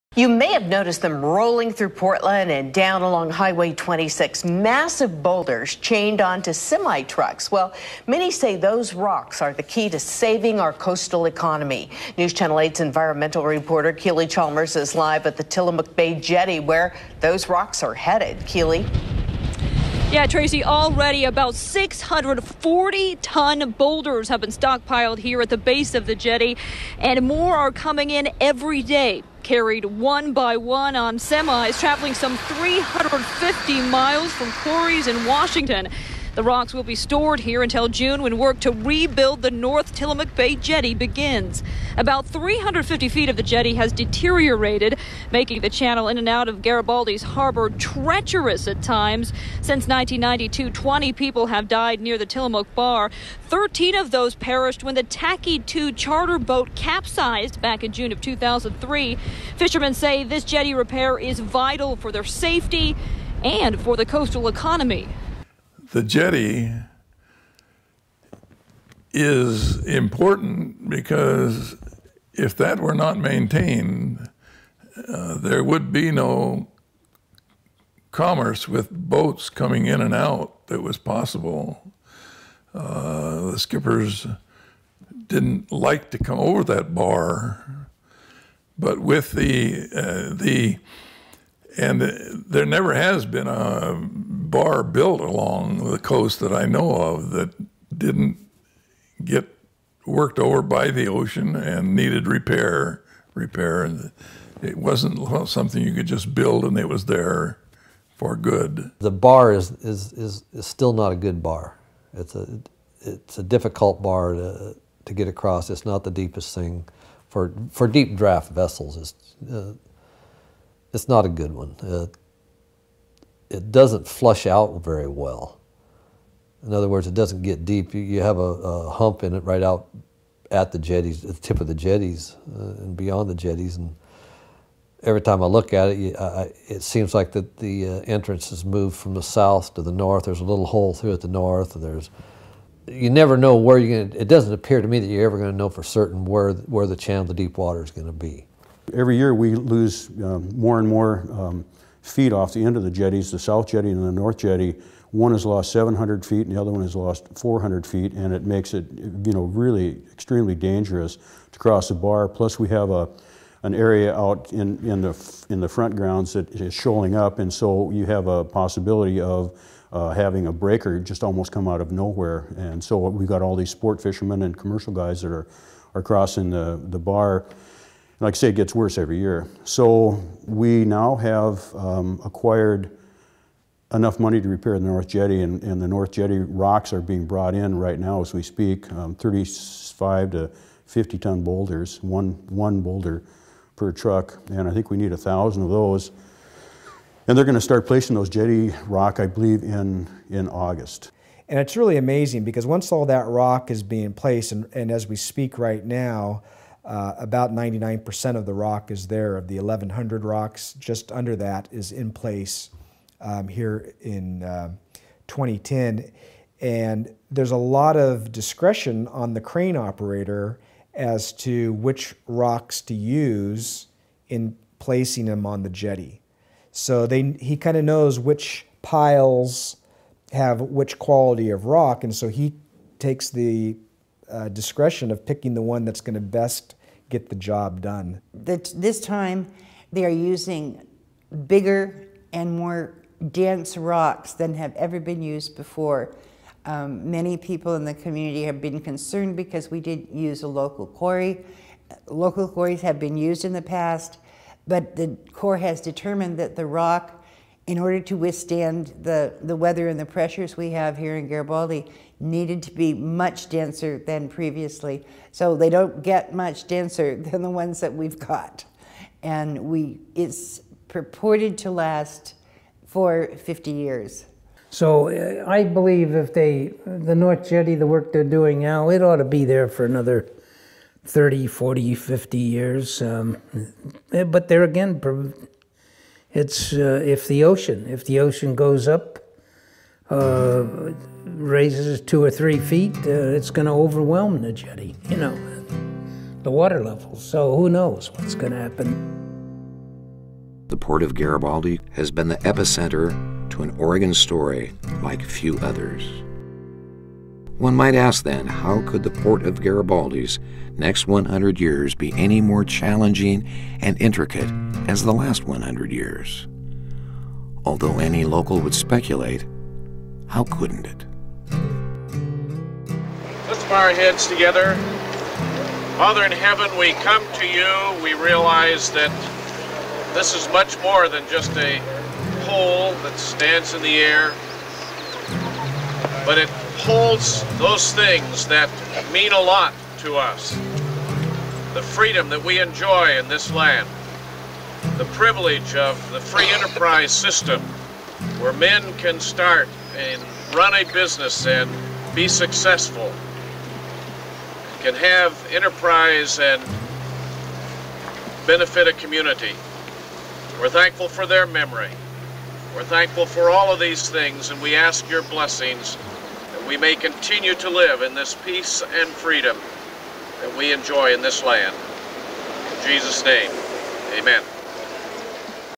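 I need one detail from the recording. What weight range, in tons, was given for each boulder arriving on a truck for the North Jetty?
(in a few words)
35 to 50 tons.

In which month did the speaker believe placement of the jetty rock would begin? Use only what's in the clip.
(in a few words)
August.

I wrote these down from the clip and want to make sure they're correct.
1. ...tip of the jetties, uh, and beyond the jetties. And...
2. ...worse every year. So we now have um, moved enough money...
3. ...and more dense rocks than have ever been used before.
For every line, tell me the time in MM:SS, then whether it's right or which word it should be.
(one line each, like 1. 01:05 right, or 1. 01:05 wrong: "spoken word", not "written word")
1. 02:11 right
2. 02:58 wrong: "acquired", not "moved"
3. 04:02 right.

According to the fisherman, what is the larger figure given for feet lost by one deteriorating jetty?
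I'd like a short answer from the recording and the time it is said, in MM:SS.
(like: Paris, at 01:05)
700 feet, at 02:35.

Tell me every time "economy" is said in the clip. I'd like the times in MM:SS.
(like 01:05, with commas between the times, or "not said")
00:11, 01:04.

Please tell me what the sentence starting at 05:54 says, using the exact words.
Can have enterprise and benefit a community.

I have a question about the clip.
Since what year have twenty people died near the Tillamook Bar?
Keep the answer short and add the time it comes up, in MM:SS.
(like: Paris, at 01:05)
1992, at 00:49.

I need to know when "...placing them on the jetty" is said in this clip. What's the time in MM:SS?
03:44.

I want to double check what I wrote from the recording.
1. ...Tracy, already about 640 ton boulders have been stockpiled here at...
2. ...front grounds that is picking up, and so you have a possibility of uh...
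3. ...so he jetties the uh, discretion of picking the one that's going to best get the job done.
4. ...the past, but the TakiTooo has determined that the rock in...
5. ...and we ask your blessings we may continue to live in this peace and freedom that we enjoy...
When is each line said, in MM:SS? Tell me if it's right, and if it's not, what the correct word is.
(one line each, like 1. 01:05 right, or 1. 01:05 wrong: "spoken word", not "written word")
1. 00:20 right
2. 02:45 wrong: "shoaling", not "picking"
3. 03:52 wrong: "takes", not "jetties"
4. 04:13 wrong: "Corps", not "TakiTooo"
5. 06:04 right.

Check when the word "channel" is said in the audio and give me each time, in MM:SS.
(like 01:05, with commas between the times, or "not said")
00:12, 00:45, 02:26.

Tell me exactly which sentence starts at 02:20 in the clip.
There's a little hole through at the north.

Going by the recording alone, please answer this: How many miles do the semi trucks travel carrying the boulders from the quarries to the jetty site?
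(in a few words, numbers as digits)
350.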